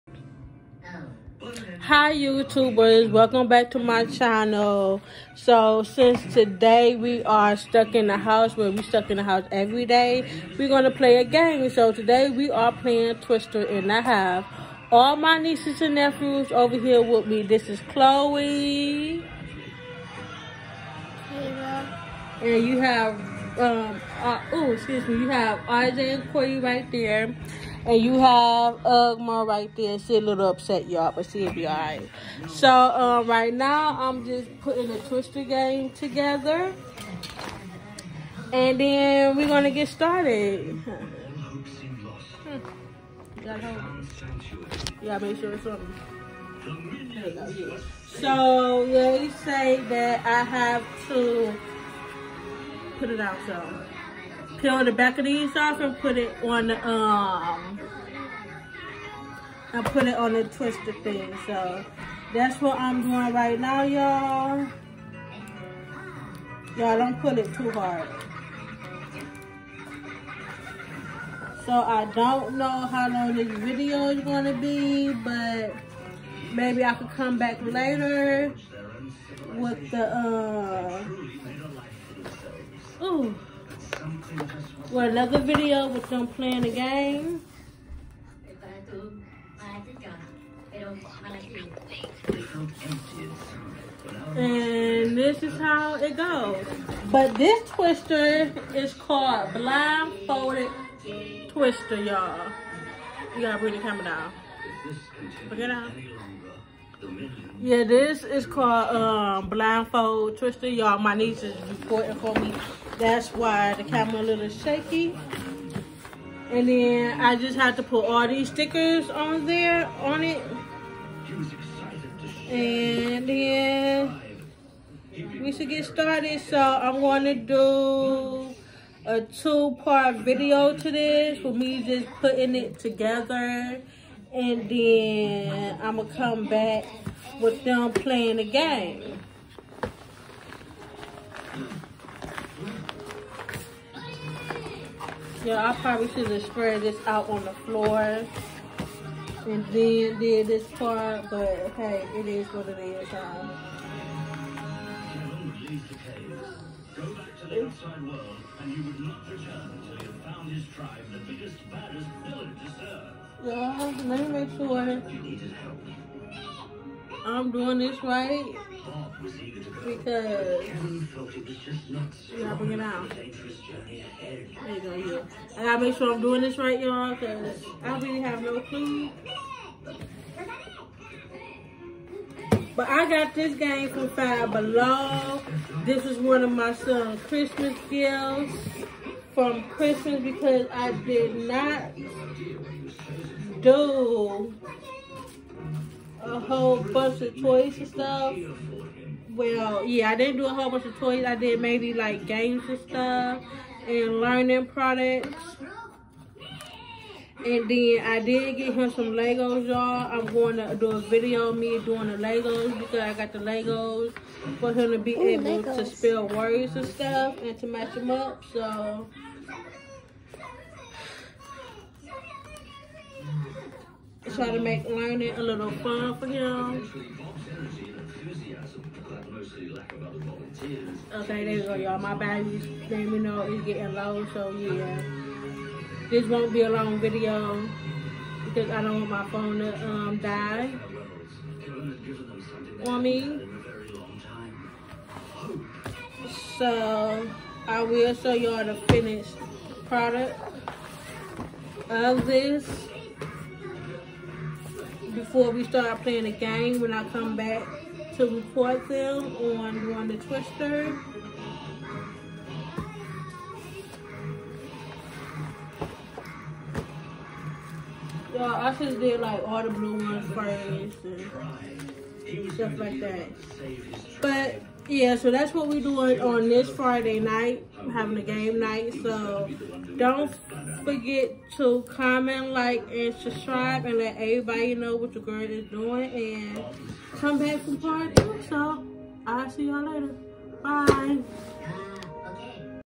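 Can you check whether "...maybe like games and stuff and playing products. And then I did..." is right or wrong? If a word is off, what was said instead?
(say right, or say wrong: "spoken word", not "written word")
wrong: "learning", not "playing".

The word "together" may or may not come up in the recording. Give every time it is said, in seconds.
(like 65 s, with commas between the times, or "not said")
35 s, 132 s.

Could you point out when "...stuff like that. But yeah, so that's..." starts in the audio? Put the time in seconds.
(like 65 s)
272 s.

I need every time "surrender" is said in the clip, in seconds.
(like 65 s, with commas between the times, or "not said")
not said.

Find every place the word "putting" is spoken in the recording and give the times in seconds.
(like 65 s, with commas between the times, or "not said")
34 s, 132 s.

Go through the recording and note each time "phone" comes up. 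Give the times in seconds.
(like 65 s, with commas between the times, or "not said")
239 s.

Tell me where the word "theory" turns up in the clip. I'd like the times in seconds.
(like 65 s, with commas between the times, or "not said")
not said.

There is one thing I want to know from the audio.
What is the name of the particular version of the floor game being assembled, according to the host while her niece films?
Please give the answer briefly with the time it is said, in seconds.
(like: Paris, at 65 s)
Blindfolded Twister, at 99 s.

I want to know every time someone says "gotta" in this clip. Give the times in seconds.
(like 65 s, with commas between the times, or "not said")
103 s, 175 s.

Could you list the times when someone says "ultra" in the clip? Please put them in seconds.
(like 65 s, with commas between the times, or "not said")
not said.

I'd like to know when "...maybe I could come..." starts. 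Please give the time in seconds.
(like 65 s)
76 s.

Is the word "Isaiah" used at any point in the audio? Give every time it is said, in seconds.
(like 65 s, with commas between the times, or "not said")
25 s.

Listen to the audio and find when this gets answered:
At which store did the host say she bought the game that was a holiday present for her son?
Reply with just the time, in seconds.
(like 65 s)
184 s.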